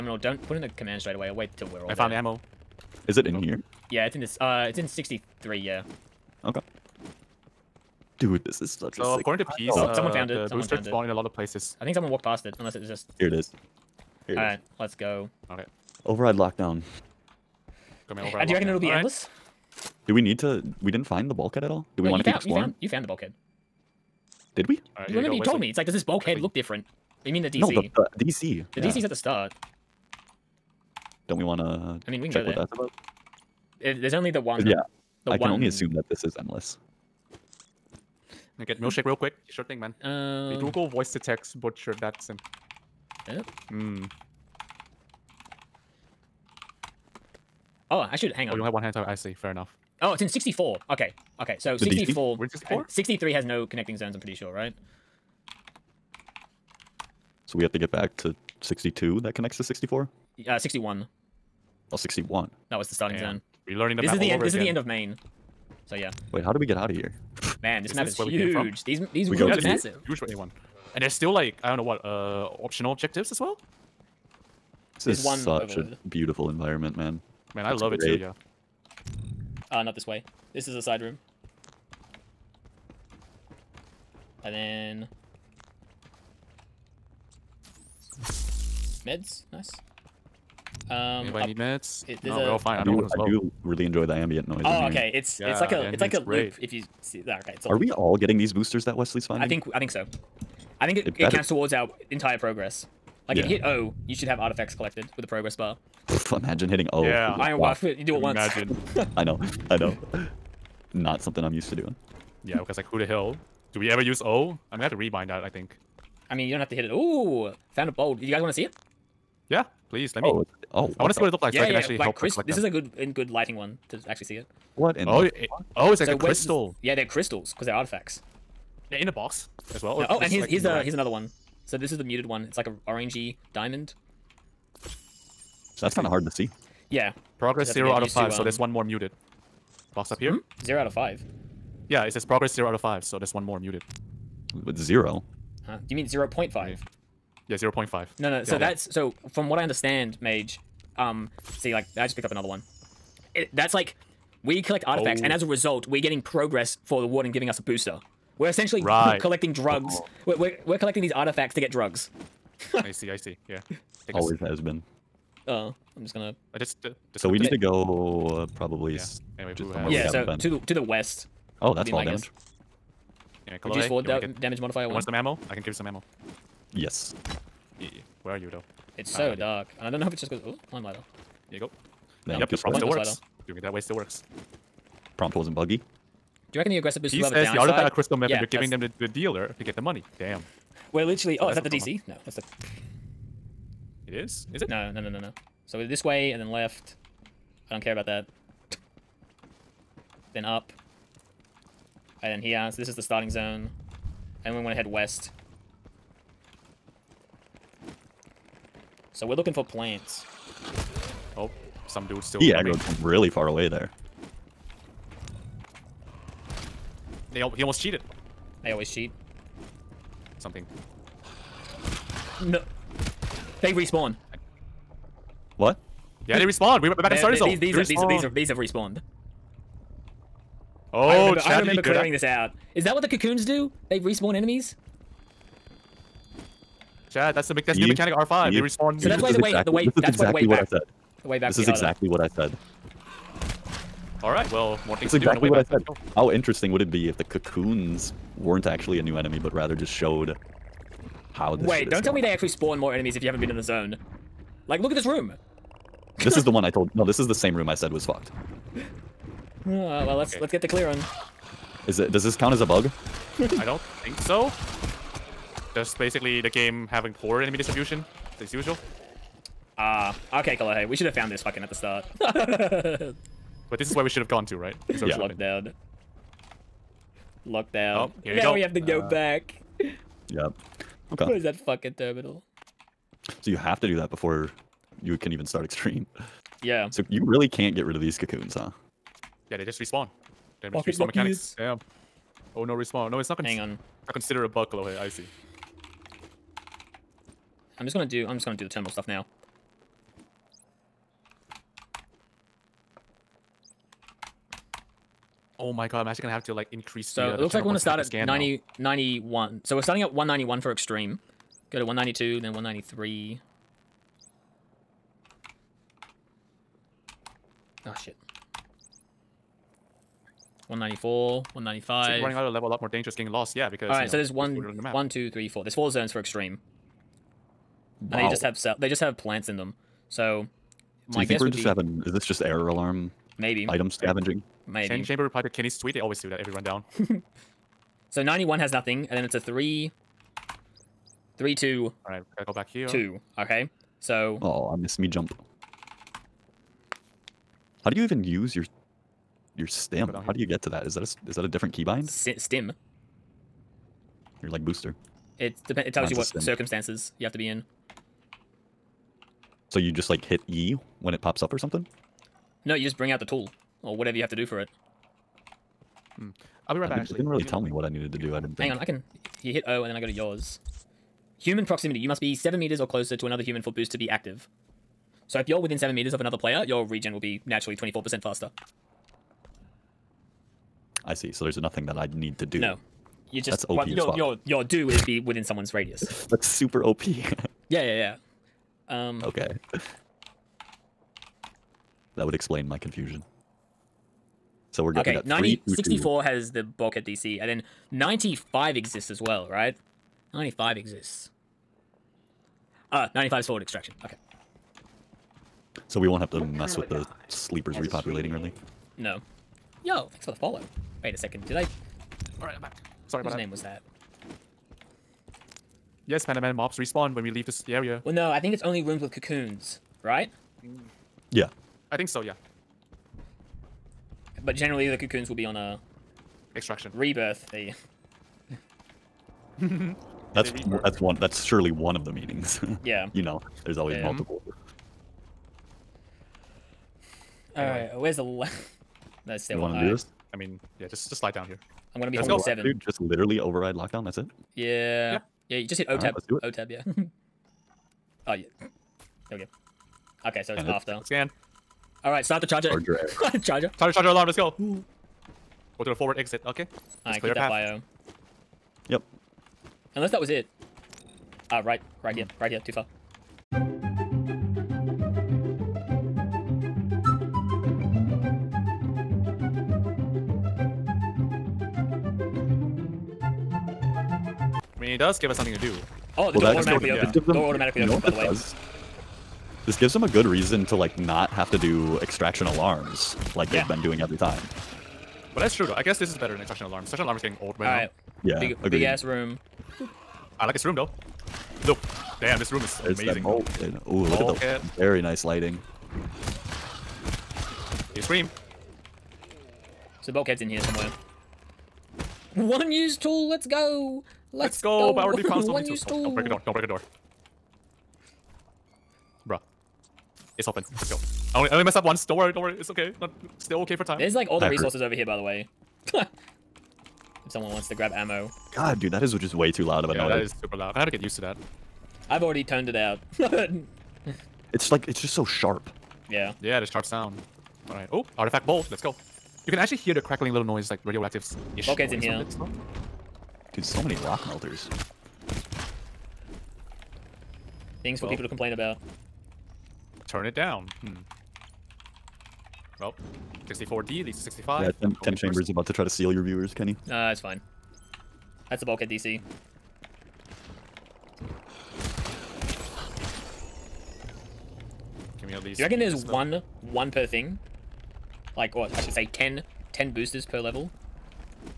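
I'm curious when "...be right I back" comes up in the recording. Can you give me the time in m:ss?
6:06.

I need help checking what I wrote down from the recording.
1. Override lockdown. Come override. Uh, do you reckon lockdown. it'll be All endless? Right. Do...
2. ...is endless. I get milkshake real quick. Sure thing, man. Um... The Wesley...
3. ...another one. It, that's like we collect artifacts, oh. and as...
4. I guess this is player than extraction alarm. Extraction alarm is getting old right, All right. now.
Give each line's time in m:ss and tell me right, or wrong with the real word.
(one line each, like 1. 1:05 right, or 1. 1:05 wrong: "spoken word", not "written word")
1. 0:16 right
2. 0:36 wrong: "Google", not "Wesley"
3. 2:32 right
4. 8:05 wrong: "better", not "player".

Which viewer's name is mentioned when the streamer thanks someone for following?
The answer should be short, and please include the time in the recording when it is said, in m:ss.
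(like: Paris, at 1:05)
Panda Man, at 6:56.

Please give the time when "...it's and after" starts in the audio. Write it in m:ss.
7:30.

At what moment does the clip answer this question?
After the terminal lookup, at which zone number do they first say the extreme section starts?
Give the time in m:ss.
5:10.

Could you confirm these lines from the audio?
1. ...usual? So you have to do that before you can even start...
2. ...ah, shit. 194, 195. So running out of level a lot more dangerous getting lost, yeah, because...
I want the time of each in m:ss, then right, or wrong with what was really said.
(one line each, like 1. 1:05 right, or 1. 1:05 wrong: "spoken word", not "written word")
1. 4:41 wrong: "terminal", not "usual"
2. 5:17 right.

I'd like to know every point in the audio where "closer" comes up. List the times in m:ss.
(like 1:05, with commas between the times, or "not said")
6:12.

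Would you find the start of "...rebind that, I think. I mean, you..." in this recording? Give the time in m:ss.
1:54.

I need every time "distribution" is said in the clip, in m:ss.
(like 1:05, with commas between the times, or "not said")
4:27.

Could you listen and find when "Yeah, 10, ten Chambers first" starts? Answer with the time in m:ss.
9:04.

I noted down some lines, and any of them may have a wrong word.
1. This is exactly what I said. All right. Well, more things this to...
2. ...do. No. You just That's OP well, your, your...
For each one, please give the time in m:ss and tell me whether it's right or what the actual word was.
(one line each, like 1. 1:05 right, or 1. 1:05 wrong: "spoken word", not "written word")
1. 4:01 right
2. 6:22 right.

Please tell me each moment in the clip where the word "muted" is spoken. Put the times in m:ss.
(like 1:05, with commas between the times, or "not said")
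2:12, 2:18, 2:23.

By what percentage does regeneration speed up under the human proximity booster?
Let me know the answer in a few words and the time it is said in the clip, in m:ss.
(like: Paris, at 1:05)
24%, at 6:17.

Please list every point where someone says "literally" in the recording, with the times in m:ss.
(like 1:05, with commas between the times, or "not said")
3:11, 7:22.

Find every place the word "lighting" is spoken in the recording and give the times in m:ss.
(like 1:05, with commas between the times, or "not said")
2:03, 8:15.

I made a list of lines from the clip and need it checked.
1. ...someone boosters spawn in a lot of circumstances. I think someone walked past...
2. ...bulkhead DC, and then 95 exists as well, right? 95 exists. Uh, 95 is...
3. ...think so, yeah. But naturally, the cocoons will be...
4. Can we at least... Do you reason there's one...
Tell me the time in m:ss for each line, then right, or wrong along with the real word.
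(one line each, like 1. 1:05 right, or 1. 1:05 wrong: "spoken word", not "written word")
1. 0:10 wrong: "places", not "circumstances"
2. 6:36 right
3. 7:01 wrong: "generally", not "naturally"
4. 9:15 wrong: "reckon", not "reason".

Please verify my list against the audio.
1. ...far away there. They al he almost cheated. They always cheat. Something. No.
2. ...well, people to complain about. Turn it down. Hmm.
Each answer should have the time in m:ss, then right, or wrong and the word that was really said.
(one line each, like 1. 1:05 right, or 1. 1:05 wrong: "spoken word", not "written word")
1. 3:33 right
2. 8:58 right.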